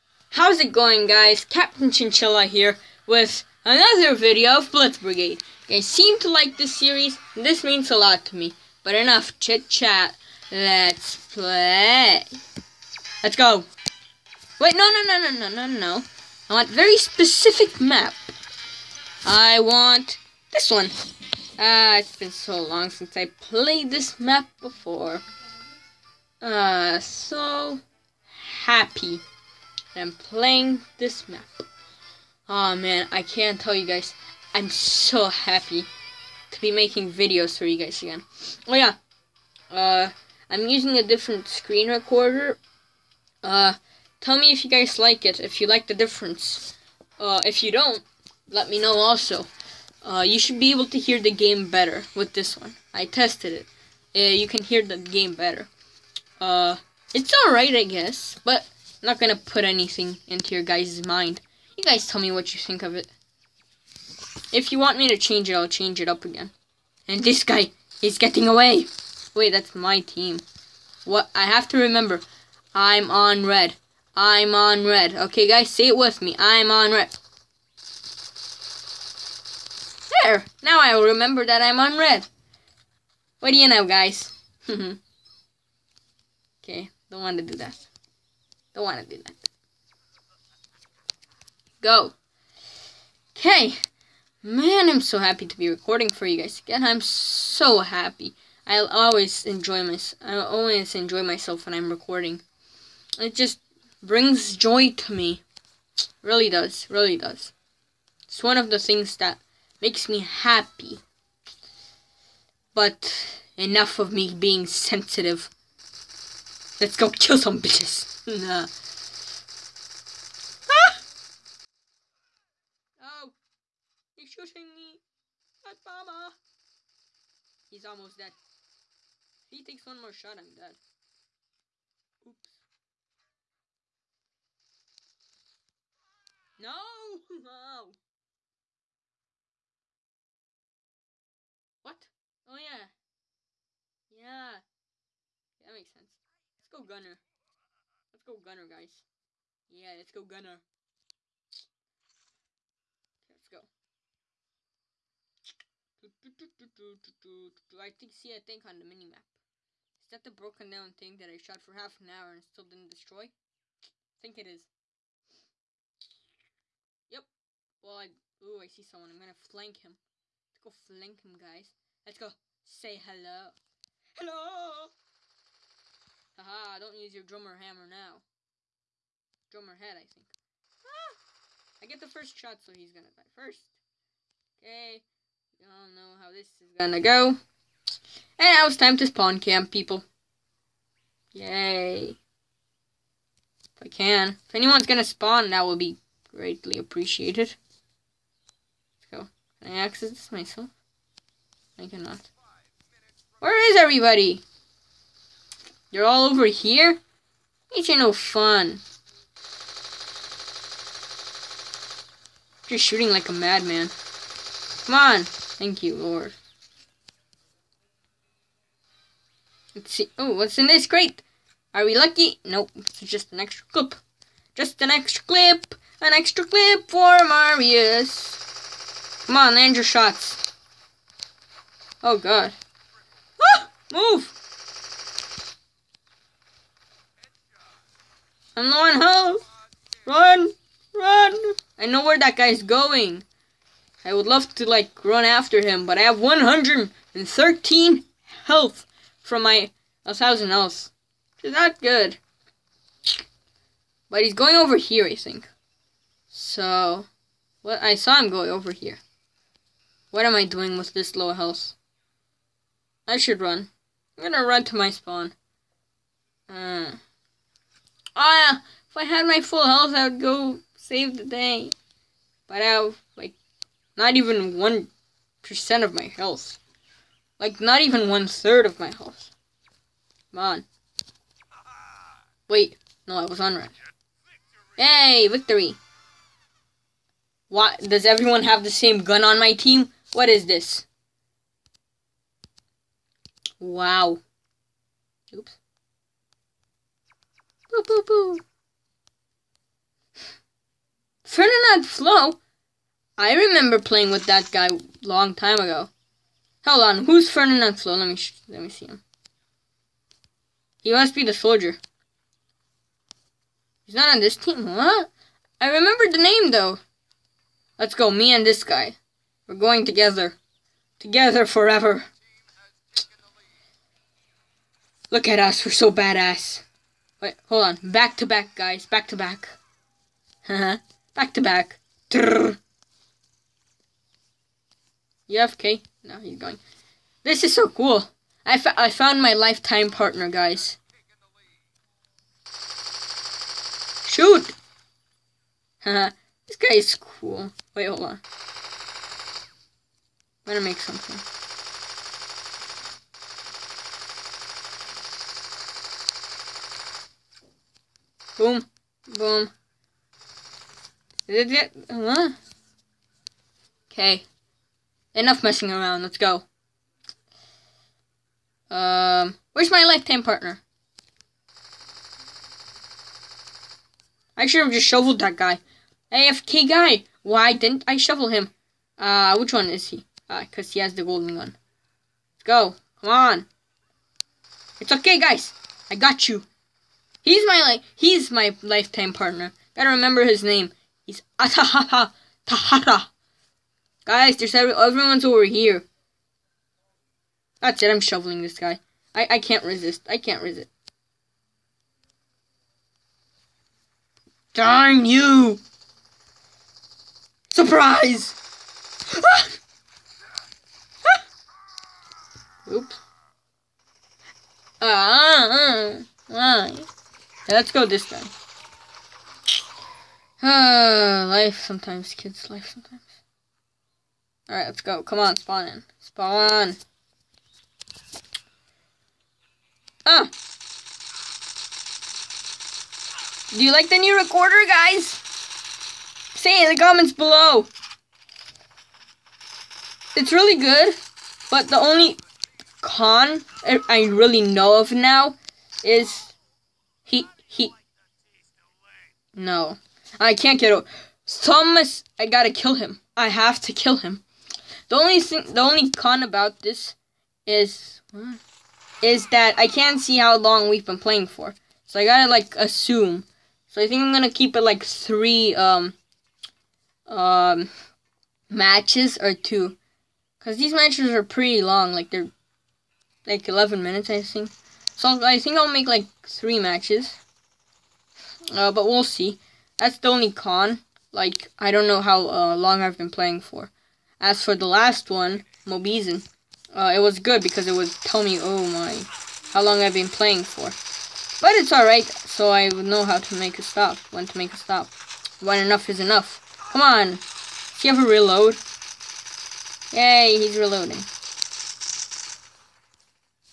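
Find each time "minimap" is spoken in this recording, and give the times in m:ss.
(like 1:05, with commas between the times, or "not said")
2:38.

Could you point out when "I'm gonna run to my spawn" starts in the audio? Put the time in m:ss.
4:24.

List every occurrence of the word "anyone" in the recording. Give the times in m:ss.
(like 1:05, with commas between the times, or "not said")
3:14.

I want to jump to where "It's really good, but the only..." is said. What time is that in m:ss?
7:20.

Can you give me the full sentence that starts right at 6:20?
Uh, cause he has the golden gun.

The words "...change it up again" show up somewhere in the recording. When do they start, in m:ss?
1:05.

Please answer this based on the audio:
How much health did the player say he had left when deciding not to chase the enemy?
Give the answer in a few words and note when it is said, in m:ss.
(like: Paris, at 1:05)
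113, at 4:06.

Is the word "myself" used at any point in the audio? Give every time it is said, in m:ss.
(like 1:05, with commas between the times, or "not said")
1:41, 3:20.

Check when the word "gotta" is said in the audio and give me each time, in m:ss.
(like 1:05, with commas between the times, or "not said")
6:29, 7:32, 7:42.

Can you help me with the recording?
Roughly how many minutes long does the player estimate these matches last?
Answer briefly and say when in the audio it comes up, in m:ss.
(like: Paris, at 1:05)
11, at 7:53.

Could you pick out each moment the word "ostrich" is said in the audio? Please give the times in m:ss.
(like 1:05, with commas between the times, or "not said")
not said.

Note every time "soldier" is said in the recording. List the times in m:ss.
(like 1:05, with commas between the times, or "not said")
5:11.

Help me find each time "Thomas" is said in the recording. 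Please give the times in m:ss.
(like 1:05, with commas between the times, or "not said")
7:31.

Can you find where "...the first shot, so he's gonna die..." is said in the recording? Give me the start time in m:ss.
3:02.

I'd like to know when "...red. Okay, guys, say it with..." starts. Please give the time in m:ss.
1:14.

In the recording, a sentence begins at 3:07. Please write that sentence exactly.
And now it's time to spawn camp, people.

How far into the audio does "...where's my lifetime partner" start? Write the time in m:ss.
6:09.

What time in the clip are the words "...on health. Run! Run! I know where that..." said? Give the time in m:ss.
3:58.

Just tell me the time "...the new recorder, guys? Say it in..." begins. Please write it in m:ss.
7:13.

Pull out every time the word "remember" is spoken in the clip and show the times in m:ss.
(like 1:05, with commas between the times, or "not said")
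1:11, 1:21, 5:03, 5:15, 6:29.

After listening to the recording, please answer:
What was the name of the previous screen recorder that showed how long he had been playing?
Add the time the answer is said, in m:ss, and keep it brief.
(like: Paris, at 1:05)
Mobizen, at 8:05.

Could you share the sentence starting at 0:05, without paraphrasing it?
You seem to like this series, this means a lot to me.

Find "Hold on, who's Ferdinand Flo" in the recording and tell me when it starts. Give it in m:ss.
5:06.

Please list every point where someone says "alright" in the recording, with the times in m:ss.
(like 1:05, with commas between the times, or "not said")
0:57, 7:04, 8:11.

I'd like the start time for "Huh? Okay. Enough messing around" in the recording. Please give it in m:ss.
6:01.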